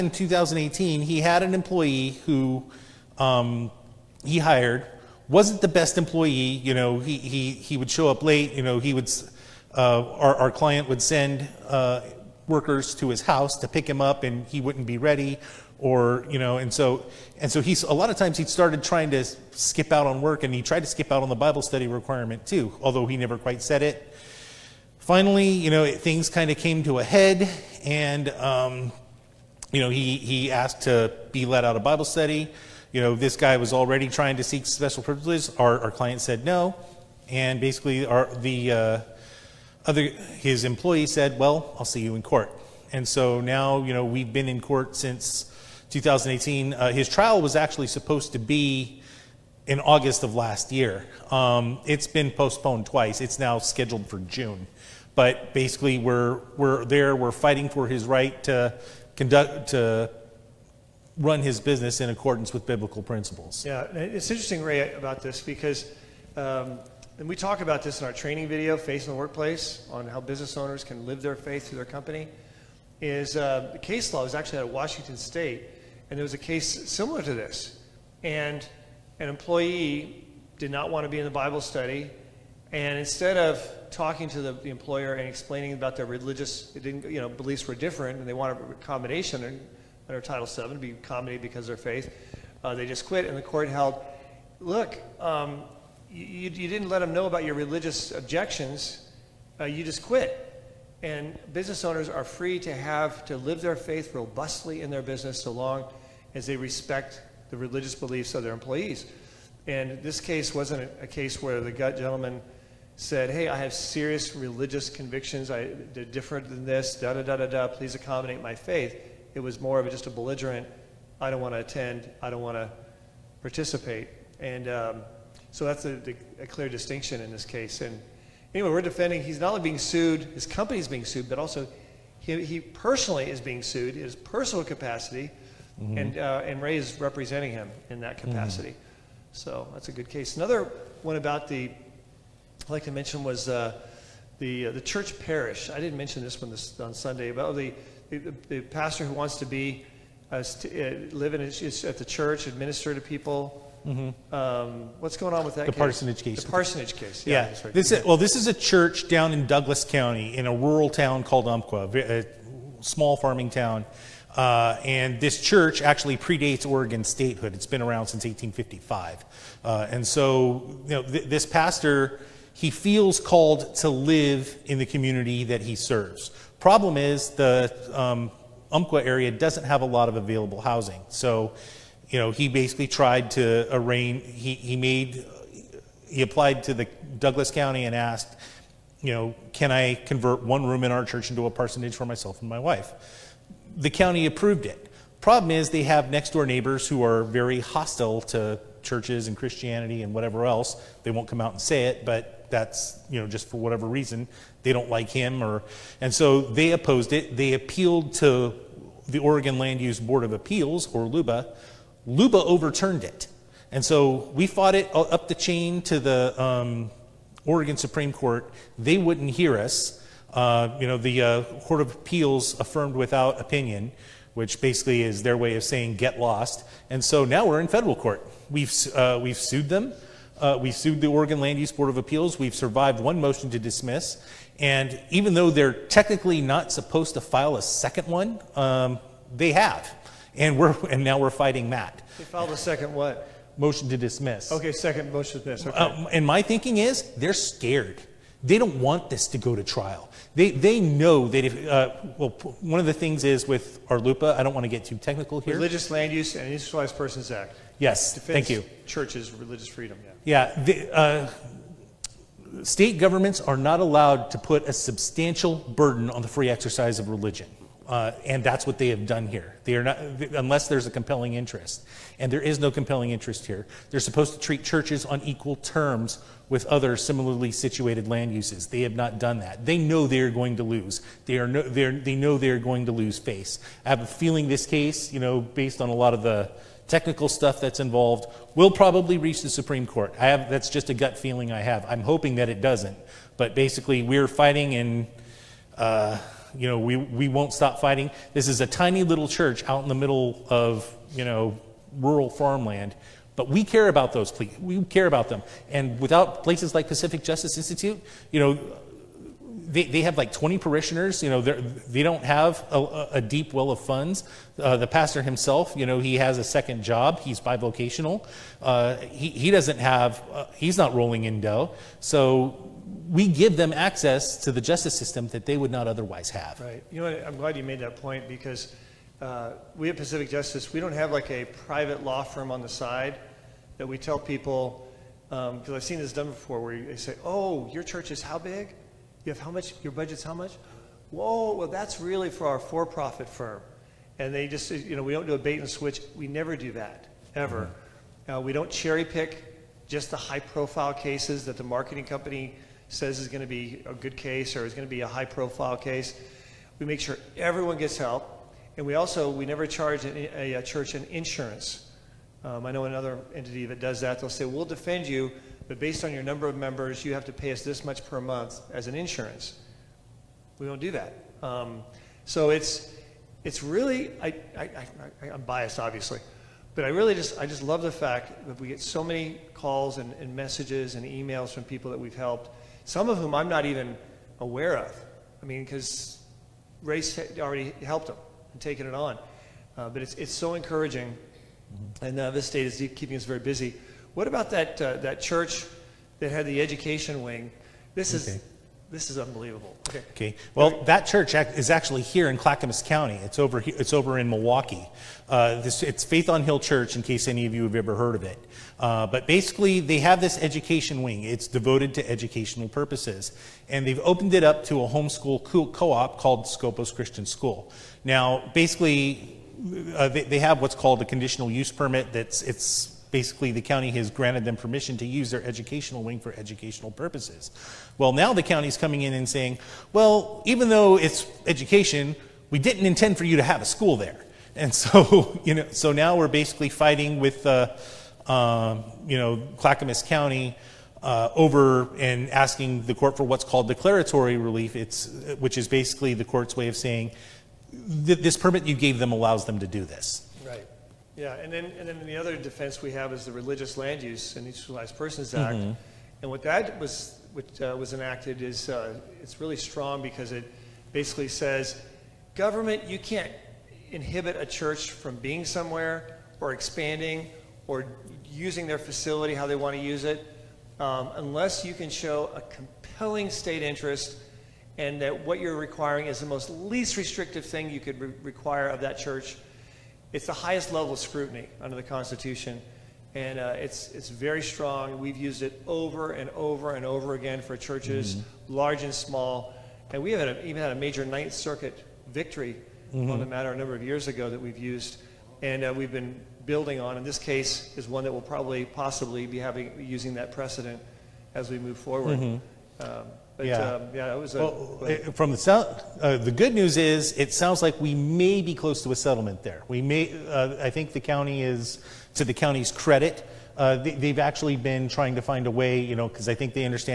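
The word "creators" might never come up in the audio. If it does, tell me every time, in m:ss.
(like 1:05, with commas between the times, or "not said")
not said.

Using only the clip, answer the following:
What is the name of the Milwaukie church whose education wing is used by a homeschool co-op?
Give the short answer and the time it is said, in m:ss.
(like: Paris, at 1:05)
Faith on Hill Church, at 6:46.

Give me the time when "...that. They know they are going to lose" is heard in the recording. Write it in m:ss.
4:39.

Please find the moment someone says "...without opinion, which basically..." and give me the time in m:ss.
3:42.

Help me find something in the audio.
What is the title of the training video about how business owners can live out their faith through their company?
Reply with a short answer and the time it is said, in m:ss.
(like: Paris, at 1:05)
Faith in the Workplace, at 1:08.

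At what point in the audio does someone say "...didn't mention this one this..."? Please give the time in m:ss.
2:25.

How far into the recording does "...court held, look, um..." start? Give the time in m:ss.
1:33.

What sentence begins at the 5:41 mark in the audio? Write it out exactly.
Whoa, well, that's really for our for profit firm.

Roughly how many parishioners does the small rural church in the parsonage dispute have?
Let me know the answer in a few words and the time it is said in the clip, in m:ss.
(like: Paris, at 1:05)
20, at 5:10.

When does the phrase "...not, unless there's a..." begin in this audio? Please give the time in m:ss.
4:29.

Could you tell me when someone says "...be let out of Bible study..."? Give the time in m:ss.
0:31.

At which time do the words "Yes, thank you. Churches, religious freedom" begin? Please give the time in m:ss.
4:17.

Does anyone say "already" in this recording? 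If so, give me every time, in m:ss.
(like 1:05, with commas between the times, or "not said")
0:33, 6:27.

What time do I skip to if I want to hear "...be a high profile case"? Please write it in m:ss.
5:54.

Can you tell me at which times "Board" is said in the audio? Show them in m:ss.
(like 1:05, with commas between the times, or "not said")
3:29, 3:51.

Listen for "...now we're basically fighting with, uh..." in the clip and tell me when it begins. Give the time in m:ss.
7:15.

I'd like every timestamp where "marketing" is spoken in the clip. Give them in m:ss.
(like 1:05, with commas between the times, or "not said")
5:51.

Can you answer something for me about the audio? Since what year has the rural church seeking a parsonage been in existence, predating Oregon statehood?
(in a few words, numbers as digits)
1855.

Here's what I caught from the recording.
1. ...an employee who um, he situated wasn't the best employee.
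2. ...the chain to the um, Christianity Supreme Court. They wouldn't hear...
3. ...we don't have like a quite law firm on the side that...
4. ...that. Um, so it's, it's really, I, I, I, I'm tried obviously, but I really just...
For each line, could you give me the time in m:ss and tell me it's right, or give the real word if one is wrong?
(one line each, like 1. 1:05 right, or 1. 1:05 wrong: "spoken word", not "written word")
1. 0:01 wrong: "hired", not "situated"
2. 3:35 wrong: "Oregon", not "Christianity"
3. 5:30 wrong: "private", not "quite"
4. 6:10 wrong: "biased", not "tried".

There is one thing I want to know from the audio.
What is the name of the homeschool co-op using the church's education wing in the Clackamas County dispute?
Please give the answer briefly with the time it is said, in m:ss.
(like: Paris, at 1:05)
Scopus Christian School, at 6:56.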